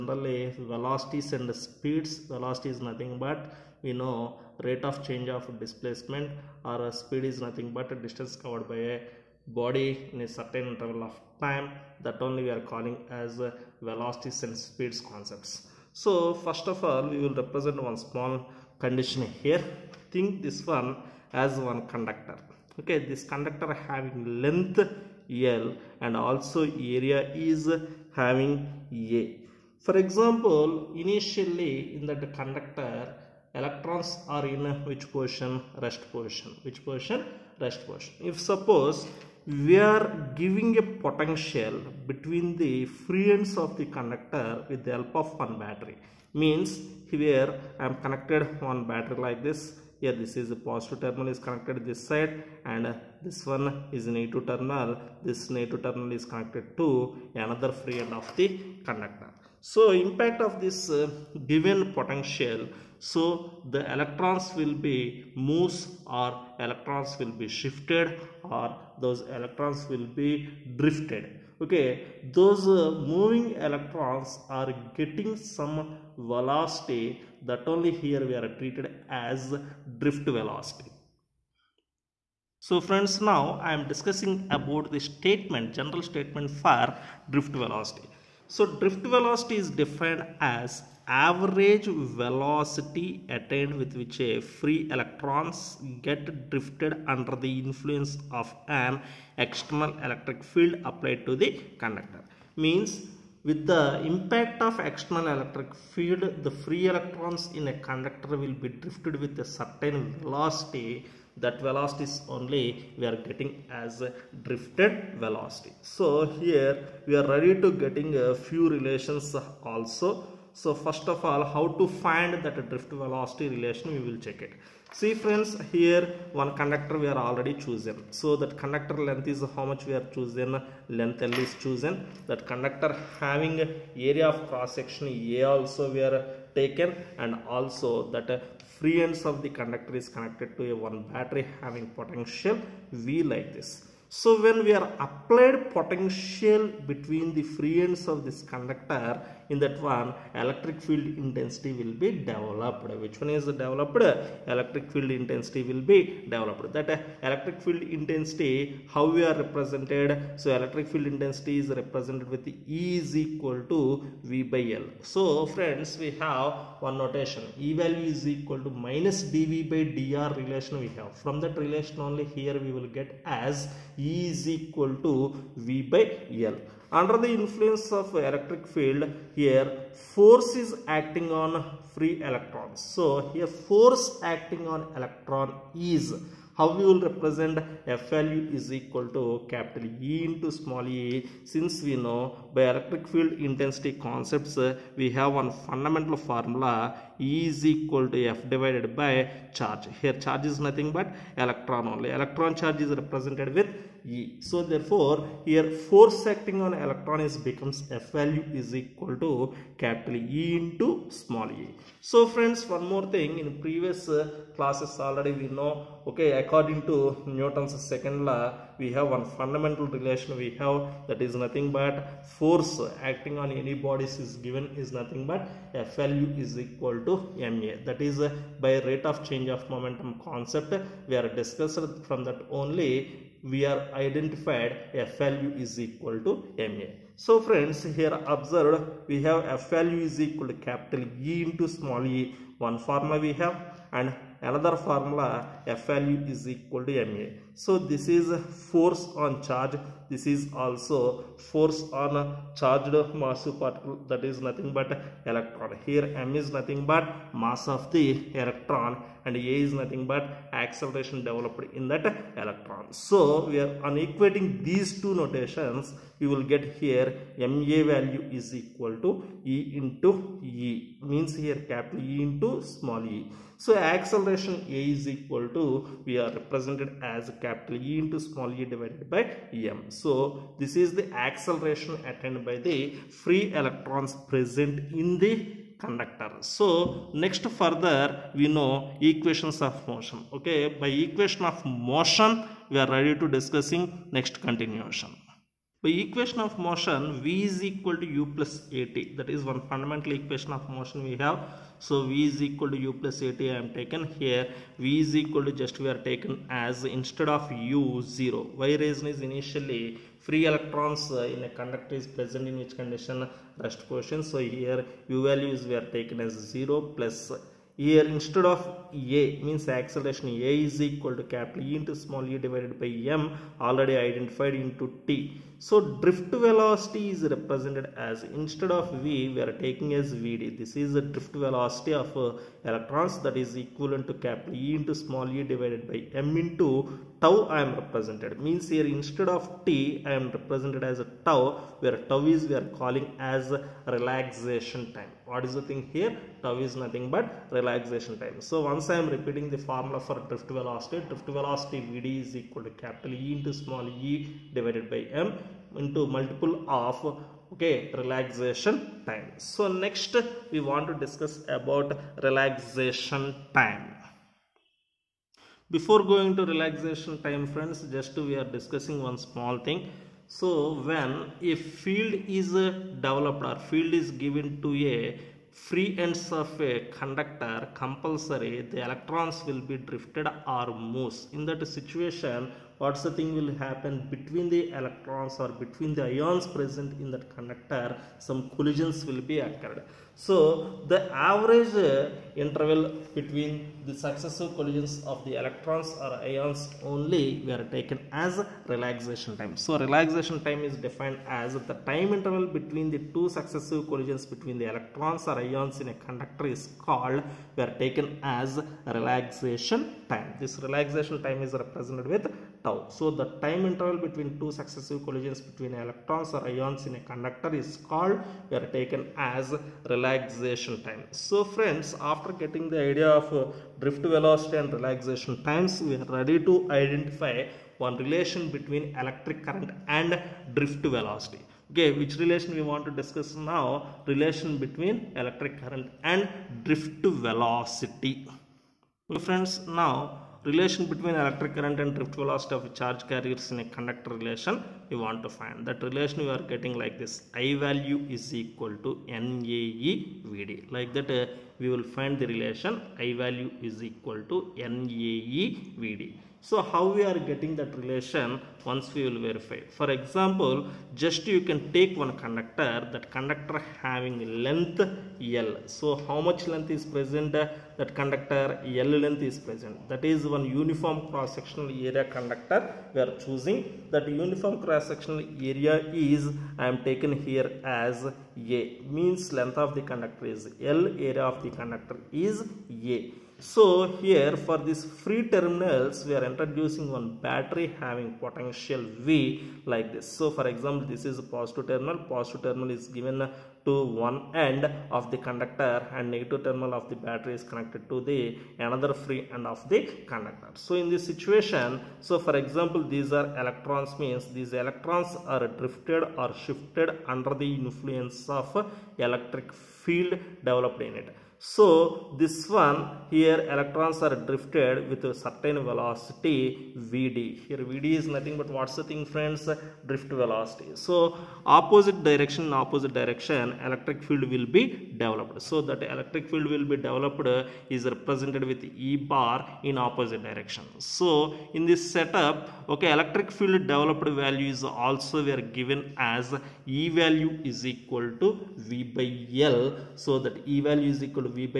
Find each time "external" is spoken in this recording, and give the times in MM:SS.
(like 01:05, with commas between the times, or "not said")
01:39, 01:44.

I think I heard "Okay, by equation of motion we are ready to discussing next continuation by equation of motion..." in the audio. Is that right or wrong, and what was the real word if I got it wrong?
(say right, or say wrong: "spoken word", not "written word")
right.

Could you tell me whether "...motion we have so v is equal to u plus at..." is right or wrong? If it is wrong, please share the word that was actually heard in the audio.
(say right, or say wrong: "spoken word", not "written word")
right.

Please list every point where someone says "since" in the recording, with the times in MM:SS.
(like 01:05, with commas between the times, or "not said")
03:11.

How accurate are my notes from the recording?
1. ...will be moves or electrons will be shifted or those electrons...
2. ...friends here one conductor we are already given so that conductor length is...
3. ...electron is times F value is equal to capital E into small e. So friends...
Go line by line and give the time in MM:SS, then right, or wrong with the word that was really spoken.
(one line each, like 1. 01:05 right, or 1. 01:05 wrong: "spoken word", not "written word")
1. 01:04 right
2. 02:05 wrong: "chosen", not "given"
3. 03:26 wrong: "becomes", not "times".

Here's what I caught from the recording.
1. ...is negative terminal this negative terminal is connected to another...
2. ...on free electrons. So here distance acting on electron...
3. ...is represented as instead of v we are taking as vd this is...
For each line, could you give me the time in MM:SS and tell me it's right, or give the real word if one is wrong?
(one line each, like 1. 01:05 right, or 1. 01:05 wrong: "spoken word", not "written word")
1. 00:53 right
2. 03:01 wrong: "force", not "distance"
3. 05:27 right.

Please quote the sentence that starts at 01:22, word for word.
So friends now I am discussing about the statement, general statement for drift velocity.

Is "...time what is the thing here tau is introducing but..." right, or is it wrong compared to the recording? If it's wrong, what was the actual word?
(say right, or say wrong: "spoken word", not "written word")
wrong: "nothing", not "introducing".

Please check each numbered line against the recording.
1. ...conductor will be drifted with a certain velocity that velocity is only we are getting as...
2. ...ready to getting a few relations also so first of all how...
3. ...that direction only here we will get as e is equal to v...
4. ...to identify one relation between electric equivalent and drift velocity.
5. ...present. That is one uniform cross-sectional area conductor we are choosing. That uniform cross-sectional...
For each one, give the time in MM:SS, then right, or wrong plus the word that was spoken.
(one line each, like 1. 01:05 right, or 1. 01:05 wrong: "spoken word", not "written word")
1. 01:47 right
2. 01:57 right
3. 02:51 wrong: "relation", not "direction"
4. 07:06 wrong: "current", not "equivalent"
5. 07:49 right.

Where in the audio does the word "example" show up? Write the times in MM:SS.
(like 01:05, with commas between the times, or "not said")
00:30, 07:39, 08:10, 08:22.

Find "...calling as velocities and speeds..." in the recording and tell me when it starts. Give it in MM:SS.
00:12.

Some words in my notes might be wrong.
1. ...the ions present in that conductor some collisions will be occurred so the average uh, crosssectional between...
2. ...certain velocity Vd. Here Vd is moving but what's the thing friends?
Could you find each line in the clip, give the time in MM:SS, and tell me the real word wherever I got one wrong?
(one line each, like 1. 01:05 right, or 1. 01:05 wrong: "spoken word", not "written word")
1. 06:26 wrong: "interval", not "crosssectional"
2. 08:35 wrong: "nothing", not "moving".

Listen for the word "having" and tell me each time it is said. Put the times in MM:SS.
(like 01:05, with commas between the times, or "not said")
00:23, 00:28, 02:13, 02:21, 07:43, 08:07.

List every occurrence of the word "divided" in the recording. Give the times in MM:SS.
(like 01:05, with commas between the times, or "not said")
03:18, 04:38, 05:22, 05:35, 05:54.